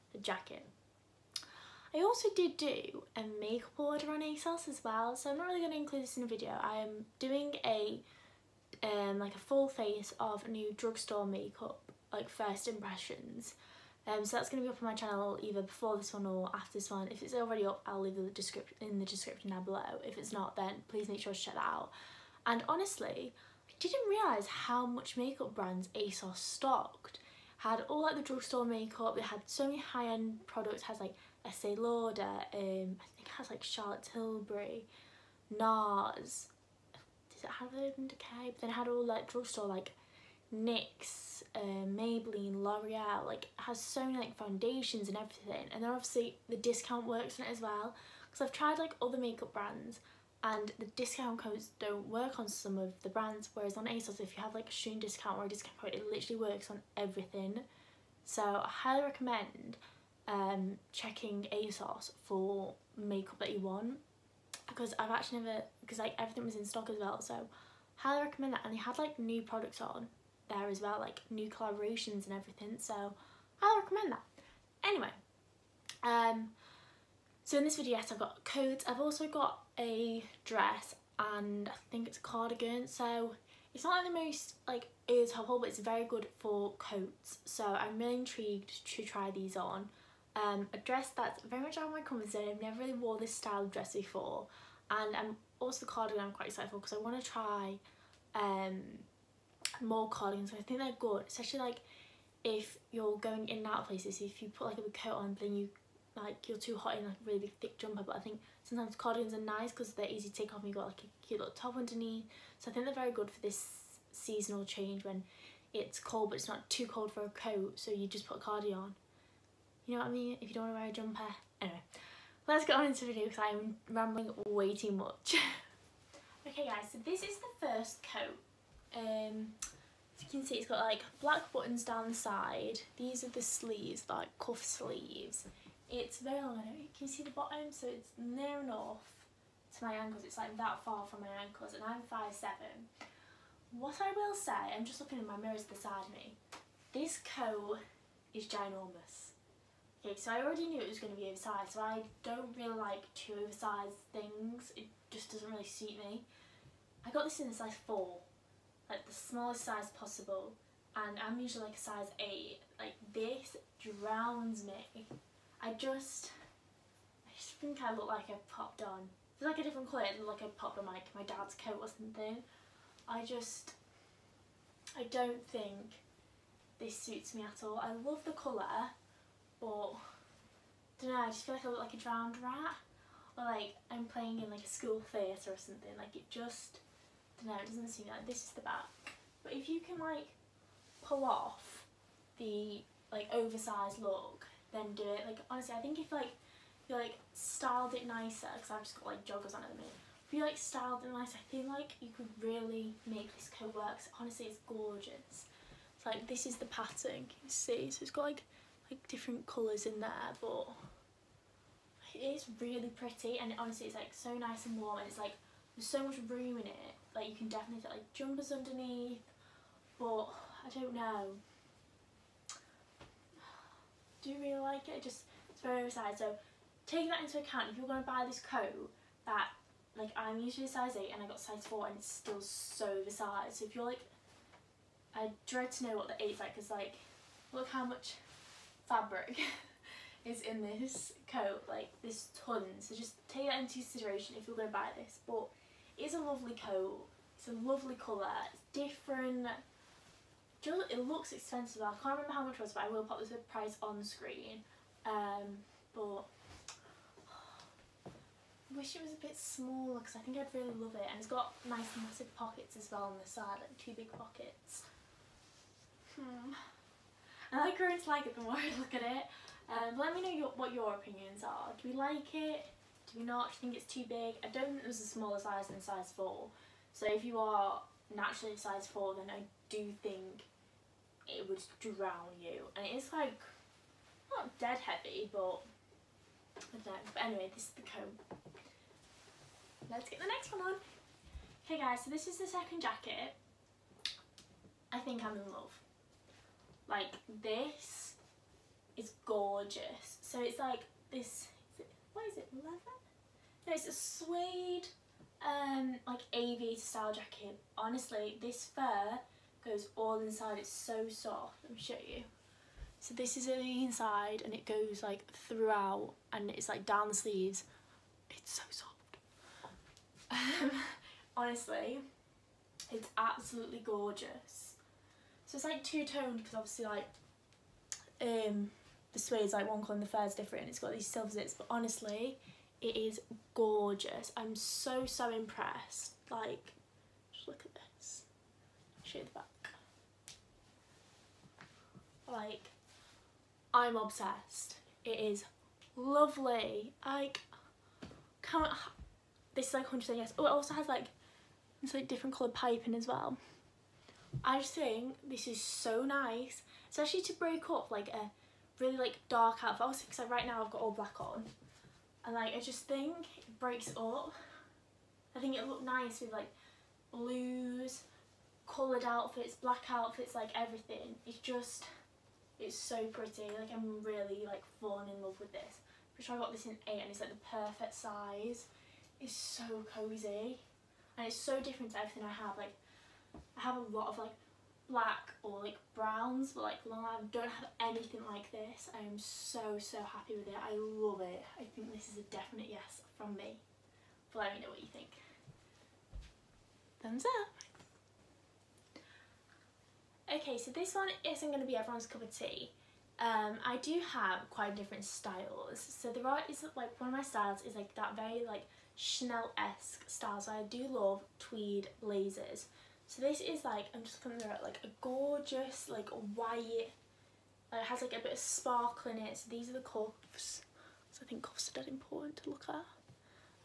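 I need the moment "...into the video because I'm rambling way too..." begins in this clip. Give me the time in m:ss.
2:02.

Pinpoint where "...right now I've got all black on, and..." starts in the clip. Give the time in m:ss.
6:00.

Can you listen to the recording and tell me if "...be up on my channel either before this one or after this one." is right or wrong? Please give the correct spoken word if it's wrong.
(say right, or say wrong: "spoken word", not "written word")
right.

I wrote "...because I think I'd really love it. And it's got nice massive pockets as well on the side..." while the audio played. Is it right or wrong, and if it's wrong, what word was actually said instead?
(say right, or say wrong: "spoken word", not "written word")
right.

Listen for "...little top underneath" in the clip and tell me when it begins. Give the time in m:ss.
1:51.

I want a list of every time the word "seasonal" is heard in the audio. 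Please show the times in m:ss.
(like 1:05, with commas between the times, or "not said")
1:54.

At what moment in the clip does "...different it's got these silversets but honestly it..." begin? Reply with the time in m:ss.
5:30.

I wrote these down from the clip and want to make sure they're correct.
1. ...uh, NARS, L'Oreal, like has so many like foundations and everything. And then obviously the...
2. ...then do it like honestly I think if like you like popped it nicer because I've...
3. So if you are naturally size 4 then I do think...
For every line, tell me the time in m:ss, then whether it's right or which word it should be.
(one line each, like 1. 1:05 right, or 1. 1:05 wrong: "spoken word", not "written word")
1. 0:41 wrong: "Maybelline", not "NARS"
2. 3:14 wrong: "styled", not "popped"
3. 4:36 right.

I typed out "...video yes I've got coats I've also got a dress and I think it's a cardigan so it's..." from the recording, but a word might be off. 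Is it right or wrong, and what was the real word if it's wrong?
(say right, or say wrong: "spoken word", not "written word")
right.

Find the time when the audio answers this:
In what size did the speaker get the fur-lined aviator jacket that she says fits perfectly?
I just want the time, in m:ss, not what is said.
6:16.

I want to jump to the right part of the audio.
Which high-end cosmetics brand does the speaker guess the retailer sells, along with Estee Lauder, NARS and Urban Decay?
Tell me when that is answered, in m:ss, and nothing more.
0:33.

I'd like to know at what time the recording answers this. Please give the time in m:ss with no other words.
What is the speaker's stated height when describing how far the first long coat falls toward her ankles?
2:22.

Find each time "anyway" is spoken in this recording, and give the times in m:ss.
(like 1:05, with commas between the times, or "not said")
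1:14, 2:01, 4:47.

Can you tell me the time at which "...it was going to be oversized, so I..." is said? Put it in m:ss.
2:30.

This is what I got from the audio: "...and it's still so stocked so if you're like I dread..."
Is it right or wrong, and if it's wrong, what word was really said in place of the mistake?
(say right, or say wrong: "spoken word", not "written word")
wrong: "oversized", not "stocked".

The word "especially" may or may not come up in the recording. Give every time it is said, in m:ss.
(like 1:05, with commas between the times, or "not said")
1:41, 5:56.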